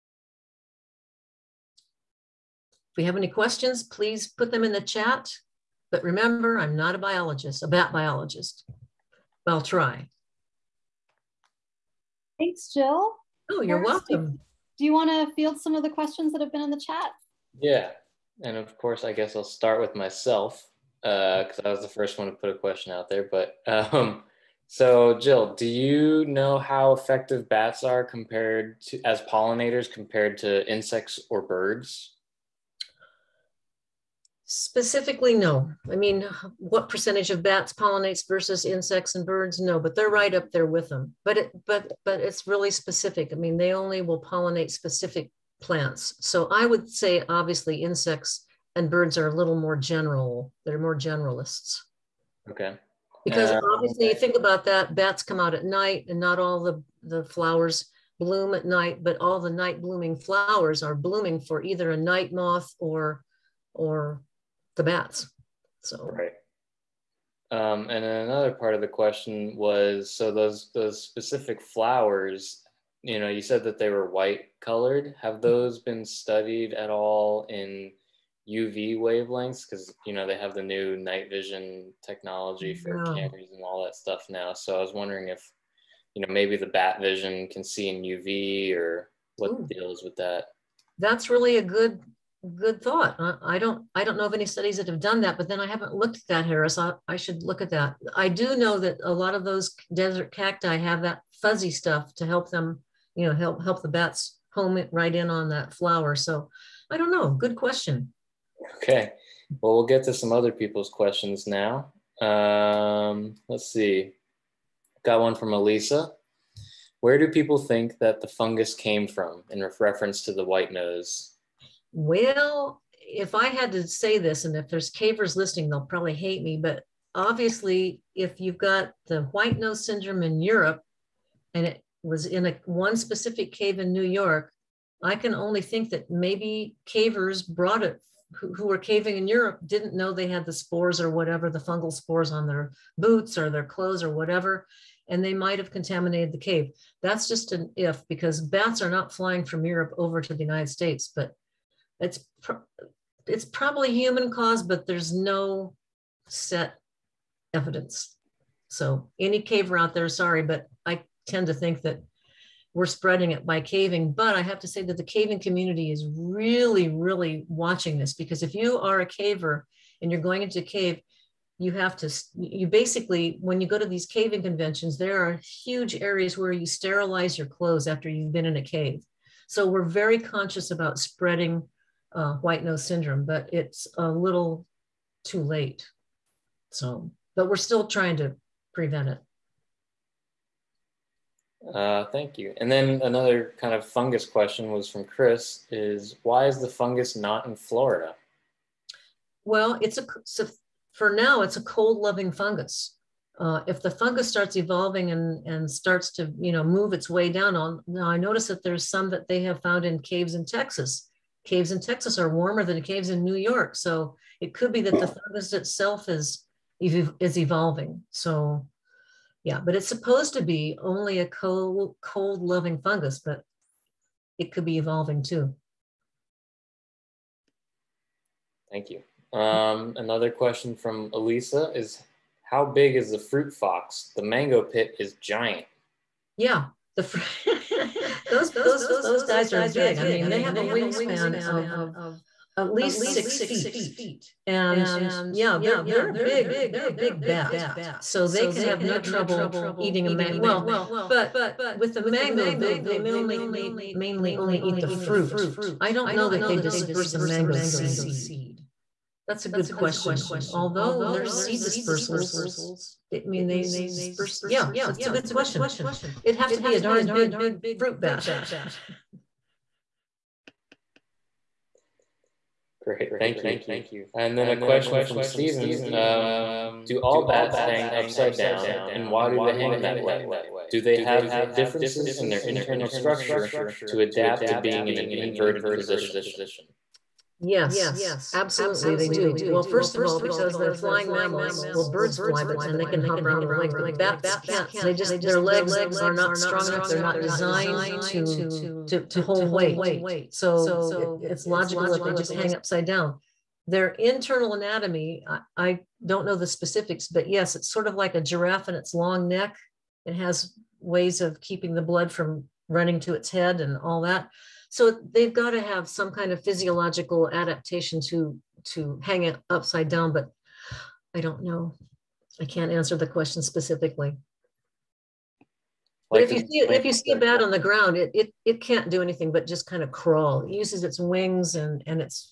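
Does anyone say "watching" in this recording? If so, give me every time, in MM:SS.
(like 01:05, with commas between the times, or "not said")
02:47.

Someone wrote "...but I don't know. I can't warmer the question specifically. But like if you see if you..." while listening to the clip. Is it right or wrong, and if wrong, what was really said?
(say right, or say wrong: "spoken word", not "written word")
wrong: "answer", not "warmer".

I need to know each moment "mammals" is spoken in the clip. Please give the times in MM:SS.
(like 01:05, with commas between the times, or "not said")
04:51.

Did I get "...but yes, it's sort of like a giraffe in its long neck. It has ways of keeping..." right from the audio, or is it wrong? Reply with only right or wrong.
right.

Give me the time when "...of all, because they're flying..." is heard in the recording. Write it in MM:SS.
04:49.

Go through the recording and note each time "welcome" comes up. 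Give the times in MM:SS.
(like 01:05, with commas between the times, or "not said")
00:14.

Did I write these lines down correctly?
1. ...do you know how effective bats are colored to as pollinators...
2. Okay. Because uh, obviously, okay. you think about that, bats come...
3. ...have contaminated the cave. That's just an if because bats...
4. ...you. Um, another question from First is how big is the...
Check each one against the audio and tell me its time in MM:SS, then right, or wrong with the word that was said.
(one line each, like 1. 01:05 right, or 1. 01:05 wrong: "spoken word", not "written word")
1. 00:25 wrong: "compared", not "colored"
2. 00:52 right
3. 02:25 right
4. 03:48 wrong: "Elisa", not "First".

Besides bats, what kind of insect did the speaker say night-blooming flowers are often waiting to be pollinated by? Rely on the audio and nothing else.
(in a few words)
Night moth.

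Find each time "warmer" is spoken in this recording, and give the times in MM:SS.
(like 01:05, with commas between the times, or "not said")
03:32.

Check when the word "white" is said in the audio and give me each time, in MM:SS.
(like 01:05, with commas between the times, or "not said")
01:14, 02:00, 02:09, 03:02.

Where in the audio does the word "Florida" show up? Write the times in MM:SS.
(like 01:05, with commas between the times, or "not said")
03:17.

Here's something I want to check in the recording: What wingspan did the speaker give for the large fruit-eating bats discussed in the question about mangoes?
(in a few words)
At least 6 feet.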